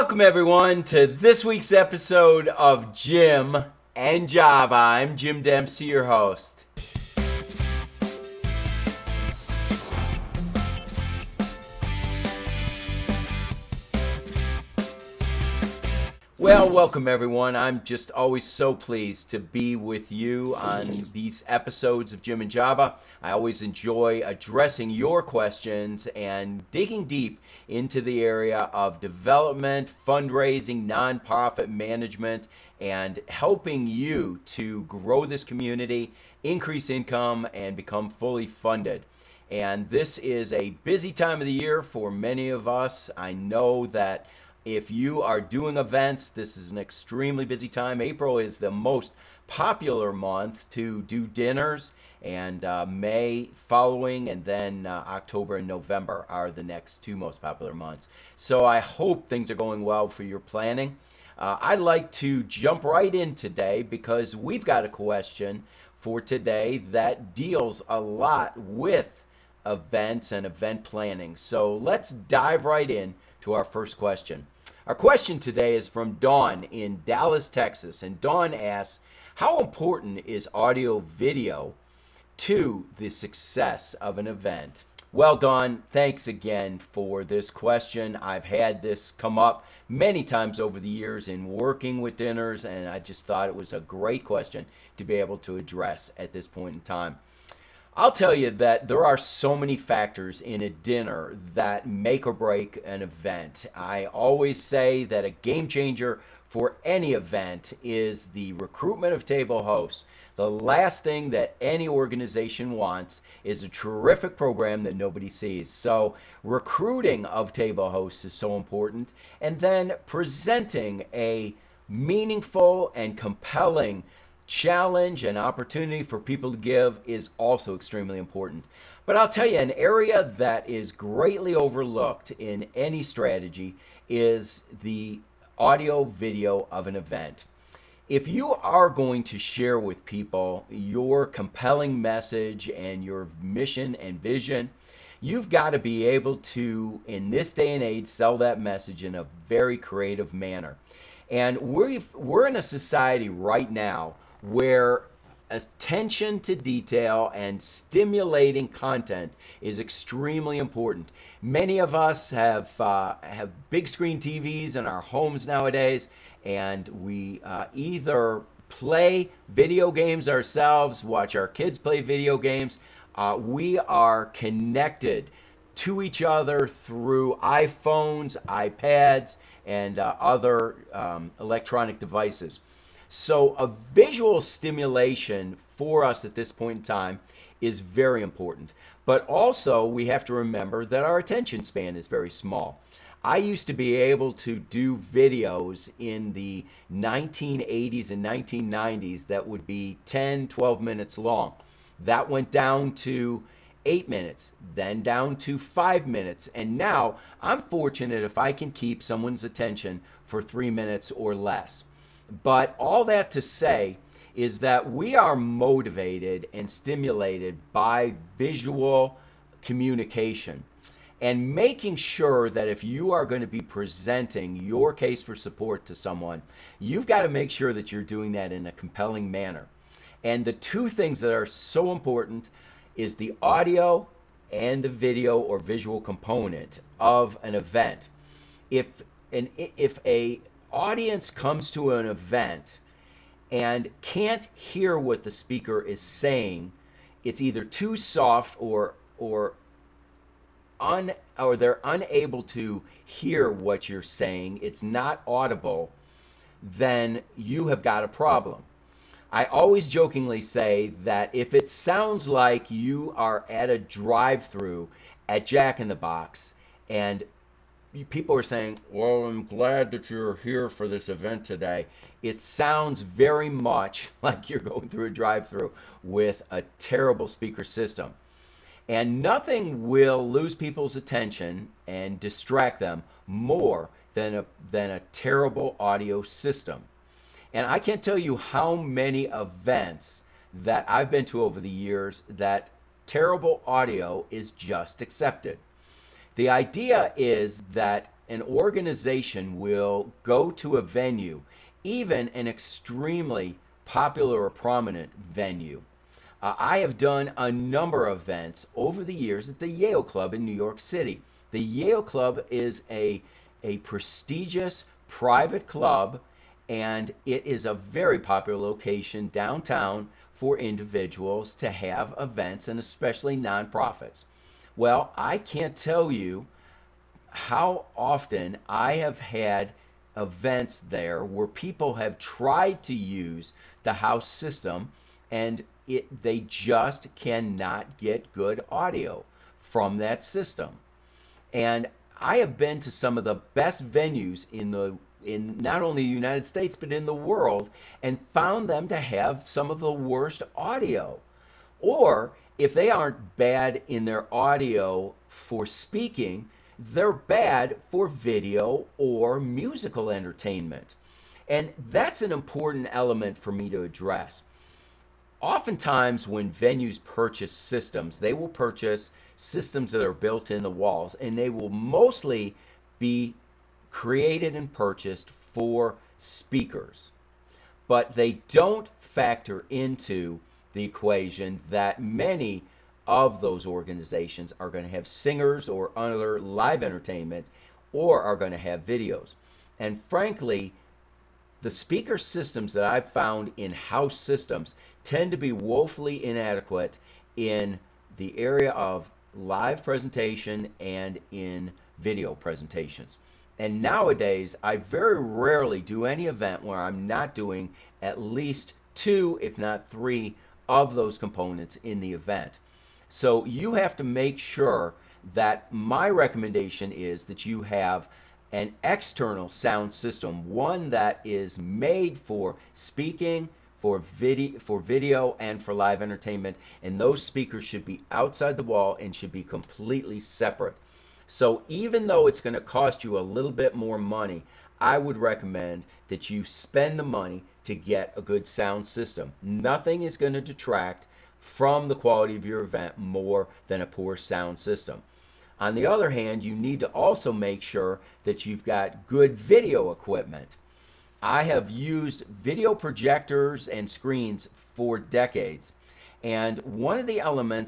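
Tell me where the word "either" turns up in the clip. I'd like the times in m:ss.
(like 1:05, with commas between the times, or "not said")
2:47, 4:07.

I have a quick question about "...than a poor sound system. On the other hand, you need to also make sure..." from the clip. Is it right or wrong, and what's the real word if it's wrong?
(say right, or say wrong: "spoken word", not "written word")
right.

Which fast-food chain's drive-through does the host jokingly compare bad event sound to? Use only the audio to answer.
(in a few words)
Jack in the Box.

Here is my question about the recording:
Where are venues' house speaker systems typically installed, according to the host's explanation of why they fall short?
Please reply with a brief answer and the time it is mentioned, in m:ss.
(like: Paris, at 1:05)
In the walls, at 6:10.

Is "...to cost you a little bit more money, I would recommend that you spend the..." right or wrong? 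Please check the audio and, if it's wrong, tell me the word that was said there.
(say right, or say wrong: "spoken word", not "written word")
right.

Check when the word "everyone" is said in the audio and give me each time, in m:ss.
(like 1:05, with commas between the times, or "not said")
0:00, 0:17.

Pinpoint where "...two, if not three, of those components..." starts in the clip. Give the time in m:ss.
6:48.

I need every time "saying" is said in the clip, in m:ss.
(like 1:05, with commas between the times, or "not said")
4:06, 4:14, 4:28.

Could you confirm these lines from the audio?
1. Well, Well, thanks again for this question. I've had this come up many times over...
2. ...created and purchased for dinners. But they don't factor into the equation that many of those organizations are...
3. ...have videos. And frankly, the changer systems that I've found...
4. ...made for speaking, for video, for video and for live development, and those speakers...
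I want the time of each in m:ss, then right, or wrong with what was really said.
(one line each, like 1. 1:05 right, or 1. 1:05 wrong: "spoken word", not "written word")
1. 1:25 wrong: "Dawn", not "Well"
2. 6:13 wrong: "speakers", not "dinners"
3. 6:28 wrong: "speaker", not "changer"
4. 7:01 wrong: "entertainment", not "development".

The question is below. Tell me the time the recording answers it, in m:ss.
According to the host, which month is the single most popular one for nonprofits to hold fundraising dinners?
0:48.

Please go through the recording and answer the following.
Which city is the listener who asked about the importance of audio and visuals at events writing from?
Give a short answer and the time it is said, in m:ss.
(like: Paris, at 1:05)
Dallas, Texas, at 1:17.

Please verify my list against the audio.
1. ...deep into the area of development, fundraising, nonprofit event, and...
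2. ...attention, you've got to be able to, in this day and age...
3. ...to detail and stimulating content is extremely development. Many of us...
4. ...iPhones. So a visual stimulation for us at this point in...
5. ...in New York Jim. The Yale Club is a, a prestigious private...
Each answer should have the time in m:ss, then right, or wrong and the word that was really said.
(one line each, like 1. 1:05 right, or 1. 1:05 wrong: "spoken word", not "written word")
1. 0:27 wrong: "management", not "event"
2. 2:24 wrong: "vision", not "attention"
3. 2:36 wrong: "important", not "development"
4. 3:01 wrong: "devices", not "iPhones"
5. 5:10 wrong: "City", not "Jim".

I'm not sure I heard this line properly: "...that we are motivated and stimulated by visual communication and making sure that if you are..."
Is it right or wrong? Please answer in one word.
right.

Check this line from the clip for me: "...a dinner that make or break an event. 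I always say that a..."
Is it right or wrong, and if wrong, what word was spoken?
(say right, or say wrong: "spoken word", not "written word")
right.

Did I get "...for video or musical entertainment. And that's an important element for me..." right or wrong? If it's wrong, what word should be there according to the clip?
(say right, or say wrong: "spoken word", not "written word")
right.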